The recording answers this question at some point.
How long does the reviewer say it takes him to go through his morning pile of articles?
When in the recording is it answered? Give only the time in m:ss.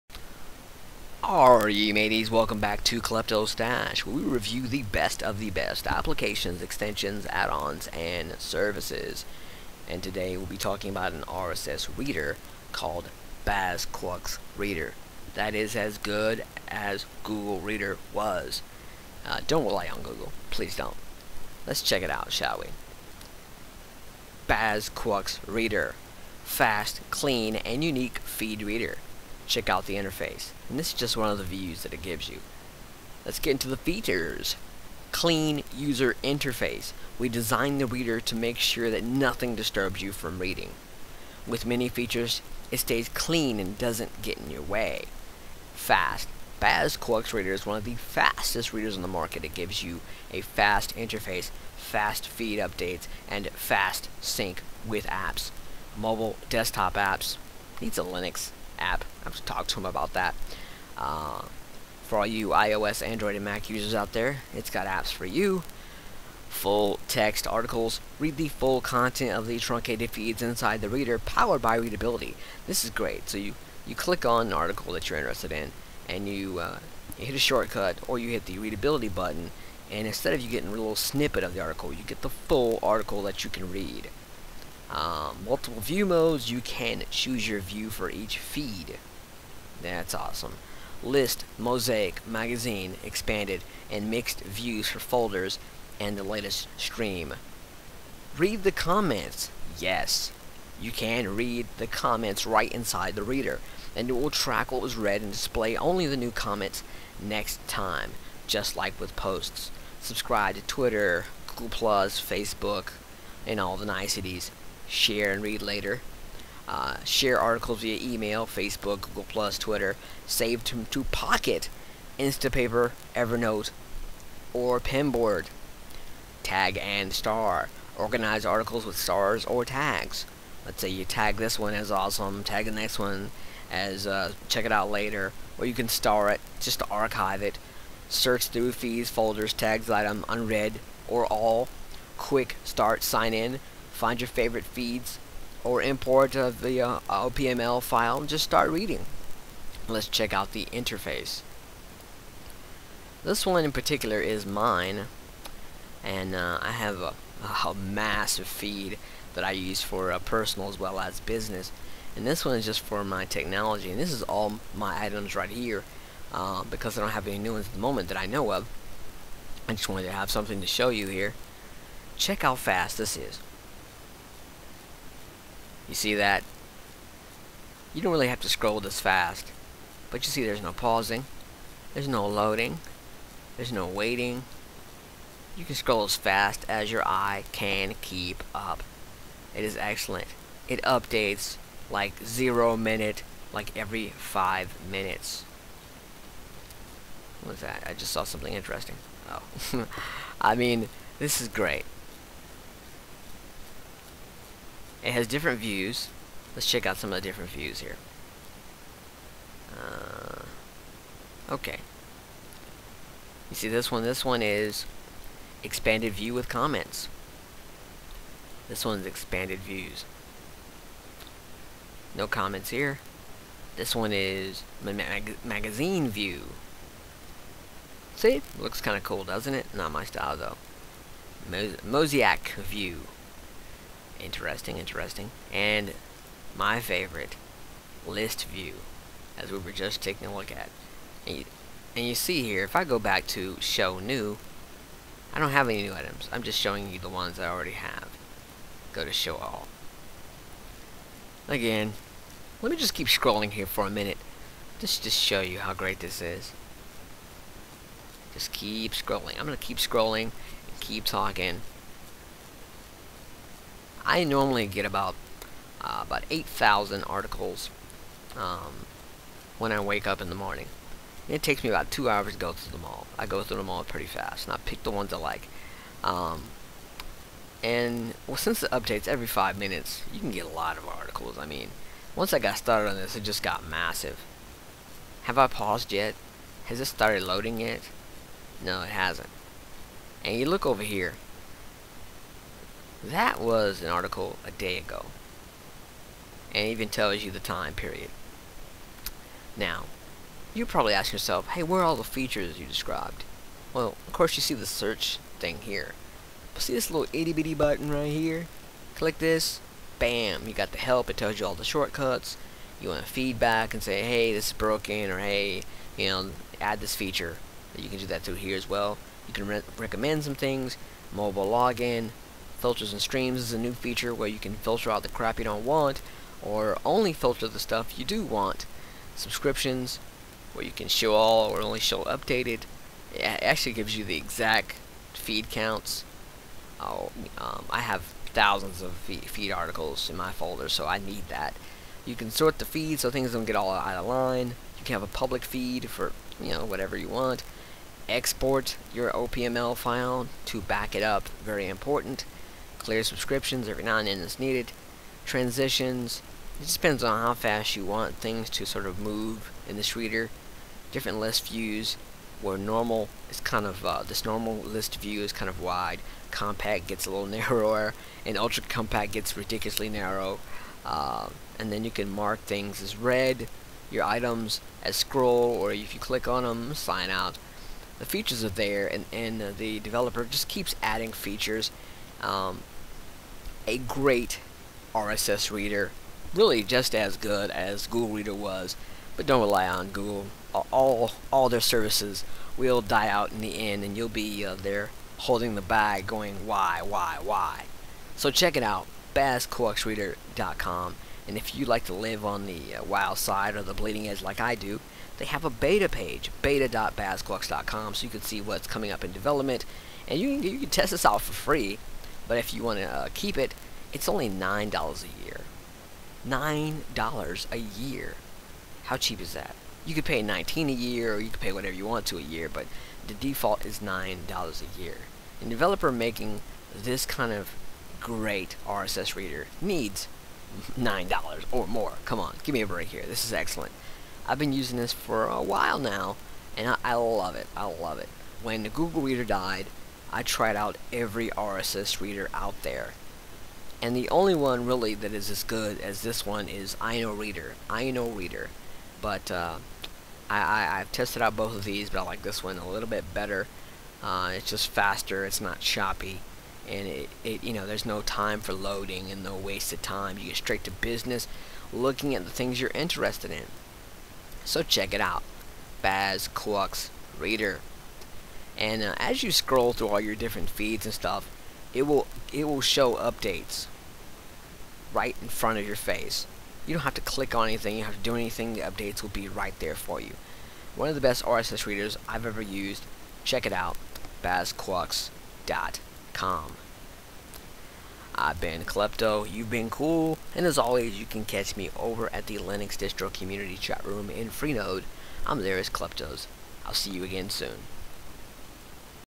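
4:31.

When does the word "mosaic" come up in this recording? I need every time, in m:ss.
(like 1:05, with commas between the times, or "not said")
1:31, 3:51.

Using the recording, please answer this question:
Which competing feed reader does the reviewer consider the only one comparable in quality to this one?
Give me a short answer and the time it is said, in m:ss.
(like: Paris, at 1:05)
Inoreader, at 7:26.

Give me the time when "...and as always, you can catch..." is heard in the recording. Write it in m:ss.
8:10.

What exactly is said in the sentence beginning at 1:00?
Uh, for all you iOS, Android, and Mac users out there, it's got apps for you.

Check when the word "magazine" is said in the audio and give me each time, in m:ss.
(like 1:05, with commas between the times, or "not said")
1:32, 3:45.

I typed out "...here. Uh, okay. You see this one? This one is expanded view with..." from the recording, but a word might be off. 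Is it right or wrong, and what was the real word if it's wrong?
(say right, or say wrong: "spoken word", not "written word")
right.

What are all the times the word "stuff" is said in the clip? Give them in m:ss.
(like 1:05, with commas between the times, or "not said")
5:27, 7:50.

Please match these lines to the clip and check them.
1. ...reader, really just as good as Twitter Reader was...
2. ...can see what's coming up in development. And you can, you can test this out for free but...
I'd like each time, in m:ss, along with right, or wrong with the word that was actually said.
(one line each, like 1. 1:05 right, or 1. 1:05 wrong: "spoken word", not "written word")
1. 6:25 wrong: "Google", not "Twitter"
2. 6:48 right.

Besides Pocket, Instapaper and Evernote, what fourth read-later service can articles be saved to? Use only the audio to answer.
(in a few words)
Pinboard.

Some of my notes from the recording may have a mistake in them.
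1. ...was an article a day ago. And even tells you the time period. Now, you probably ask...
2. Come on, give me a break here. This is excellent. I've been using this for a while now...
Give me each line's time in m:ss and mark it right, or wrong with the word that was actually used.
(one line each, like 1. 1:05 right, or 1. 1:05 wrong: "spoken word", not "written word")
1. 4:53 right
2. 7:12 right.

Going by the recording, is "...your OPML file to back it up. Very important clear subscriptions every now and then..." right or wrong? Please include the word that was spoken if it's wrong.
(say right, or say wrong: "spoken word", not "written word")
right.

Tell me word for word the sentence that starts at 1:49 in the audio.
Subscribe to Twitter, Google+, Facebook, and all the niceties share, and read later.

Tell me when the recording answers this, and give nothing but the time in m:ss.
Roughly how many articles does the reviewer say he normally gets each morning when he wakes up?
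4:26.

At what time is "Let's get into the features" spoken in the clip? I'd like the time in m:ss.
0:33.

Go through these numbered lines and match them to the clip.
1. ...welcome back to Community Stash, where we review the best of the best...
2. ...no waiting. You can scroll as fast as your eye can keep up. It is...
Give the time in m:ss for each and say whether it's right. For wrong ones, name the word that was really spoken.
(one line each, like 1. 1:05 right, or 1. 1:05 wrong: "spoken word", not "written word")
1. 0:02 wrong: "Klepto", not "Community"
2. 3:03 right.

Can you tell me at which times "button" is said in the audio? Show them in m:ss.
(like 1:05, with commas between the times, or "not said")
1:19, 5:07.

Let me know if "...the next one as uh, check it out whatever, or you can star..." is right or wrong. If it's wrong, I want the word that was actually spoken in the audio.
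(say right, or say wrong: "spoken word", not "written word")
wrong: "later", not "whatever".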